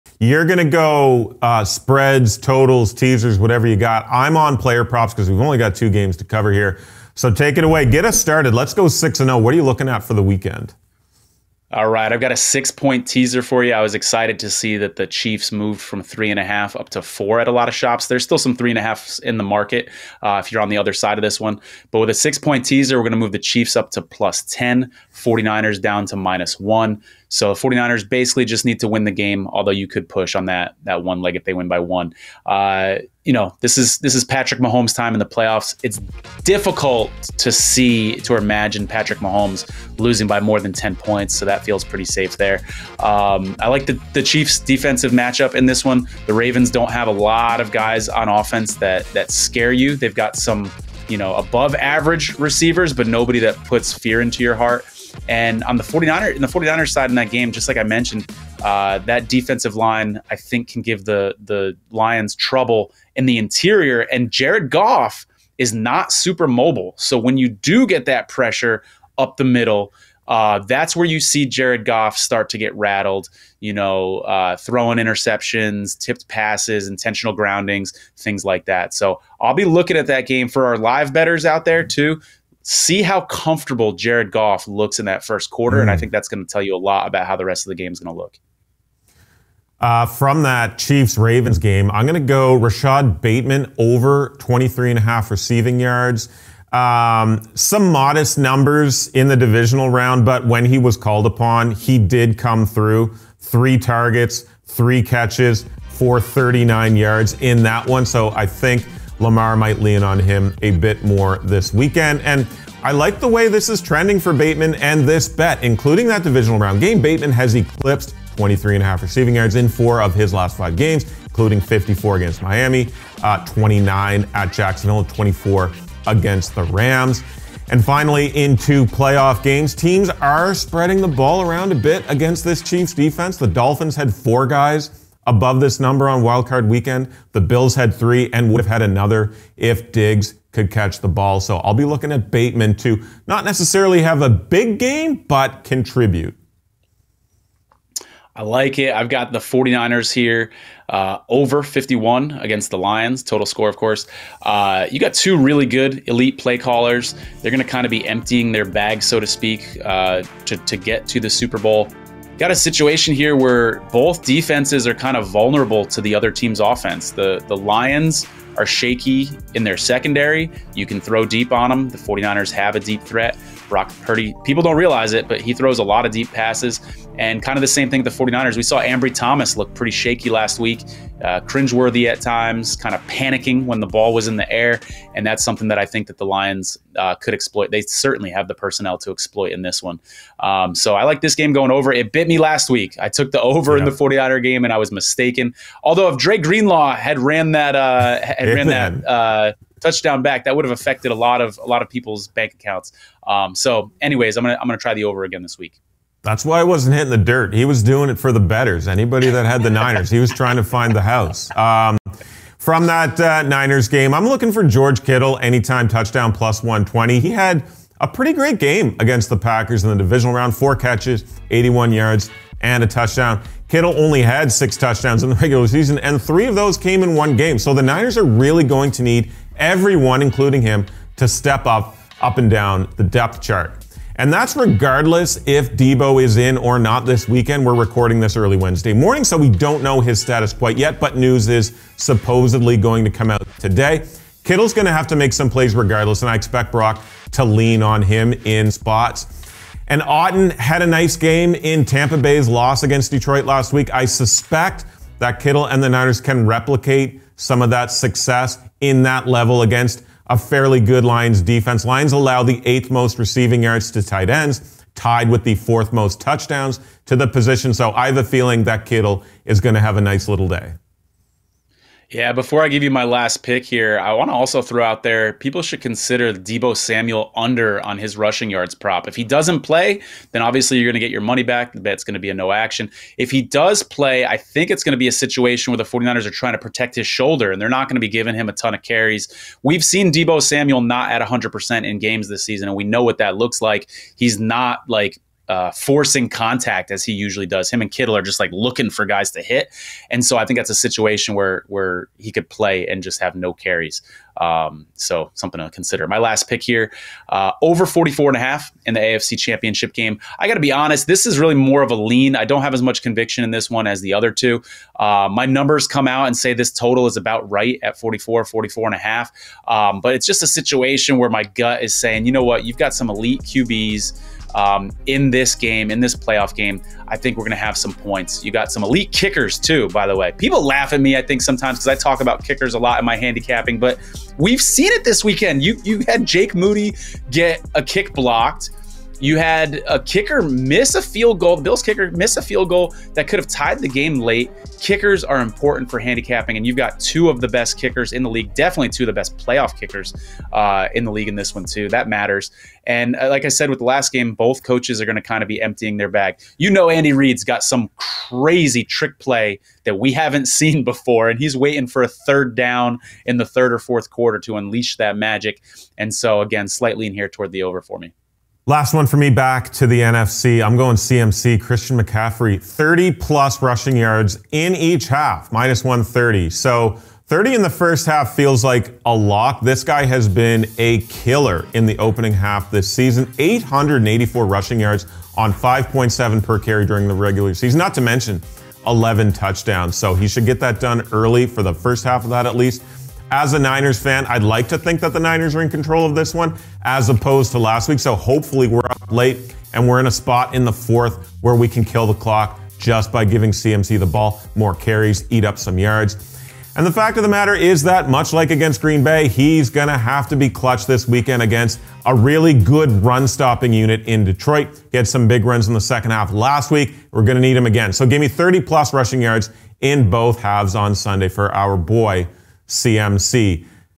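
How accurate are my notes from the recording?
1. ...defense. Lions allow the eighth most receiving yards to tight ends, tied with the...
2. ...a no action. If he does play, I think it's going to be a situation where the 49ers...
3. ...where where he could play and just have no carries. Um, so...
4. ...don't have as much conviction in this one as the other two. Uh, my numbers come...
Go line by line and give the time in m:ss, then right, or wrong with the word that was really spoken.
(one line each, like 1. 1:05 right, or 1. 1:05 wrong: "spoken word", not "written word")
1. 4:21 right
2. 4:42 right
3. 5:01 right
4. 5:12 right.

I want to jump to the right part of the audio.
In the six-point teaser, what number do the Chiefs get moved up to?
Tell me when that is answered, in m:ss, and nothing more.
0:24.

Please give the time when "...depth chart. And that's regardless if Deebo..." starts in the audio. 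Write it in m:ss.
3:53.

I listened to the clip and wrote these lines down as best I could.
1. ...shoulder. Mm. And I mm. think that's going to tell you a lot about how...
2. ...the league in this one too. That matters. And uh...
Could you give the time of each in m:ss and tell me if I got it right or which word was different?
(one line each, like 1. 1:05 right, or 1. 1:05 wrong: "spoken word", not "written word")
1. 1:25 wrong: "quarter", not "shoulder"
2. 5:51 right.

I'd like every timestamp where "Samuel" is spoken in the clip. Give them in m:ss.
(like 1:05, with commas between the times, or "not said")
4:36, 4:50.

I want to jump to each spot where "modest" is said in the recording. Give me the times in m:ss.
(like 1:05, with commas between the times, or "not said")
1:37.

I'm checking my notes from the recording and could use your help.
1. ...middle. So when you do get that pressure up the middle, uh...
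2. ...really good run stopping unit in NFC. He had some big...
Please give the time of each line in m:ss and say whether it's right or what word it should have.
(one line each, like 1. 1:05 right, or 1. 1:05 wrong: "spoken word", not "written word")
1. 1:06 wrong: "mobile", not "middle"
2. 6:52 wrong: "Detroit", not "NFC".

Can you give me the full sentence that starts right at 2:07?
And finally, into playoff games, teams are spreading the ball around a bit against this Chiefs defense.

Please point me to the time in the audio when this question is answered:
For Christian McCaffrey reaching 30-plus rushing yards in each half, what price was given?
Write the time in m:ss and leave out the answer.
6:15.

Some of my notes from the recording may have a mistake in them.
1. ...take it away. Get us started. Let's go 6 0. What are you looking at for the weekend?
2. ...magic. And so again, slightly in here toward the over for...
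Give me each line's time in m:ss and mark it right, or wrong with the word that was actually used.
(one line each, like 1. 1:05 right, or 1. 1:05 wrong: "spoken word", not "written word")
1. 0:07 right
2. 6:05 right.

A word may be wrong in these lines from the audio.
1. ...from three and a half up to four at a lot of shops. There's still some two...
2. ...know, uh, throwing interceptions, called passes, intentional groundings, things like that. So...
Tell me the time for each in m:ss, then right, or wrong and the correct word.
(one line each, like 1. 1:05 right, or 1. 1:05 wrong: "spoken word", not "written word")
1. 0:15 wrong: "three", not "two"
2. 1:13 wrong: "tipped", not "called".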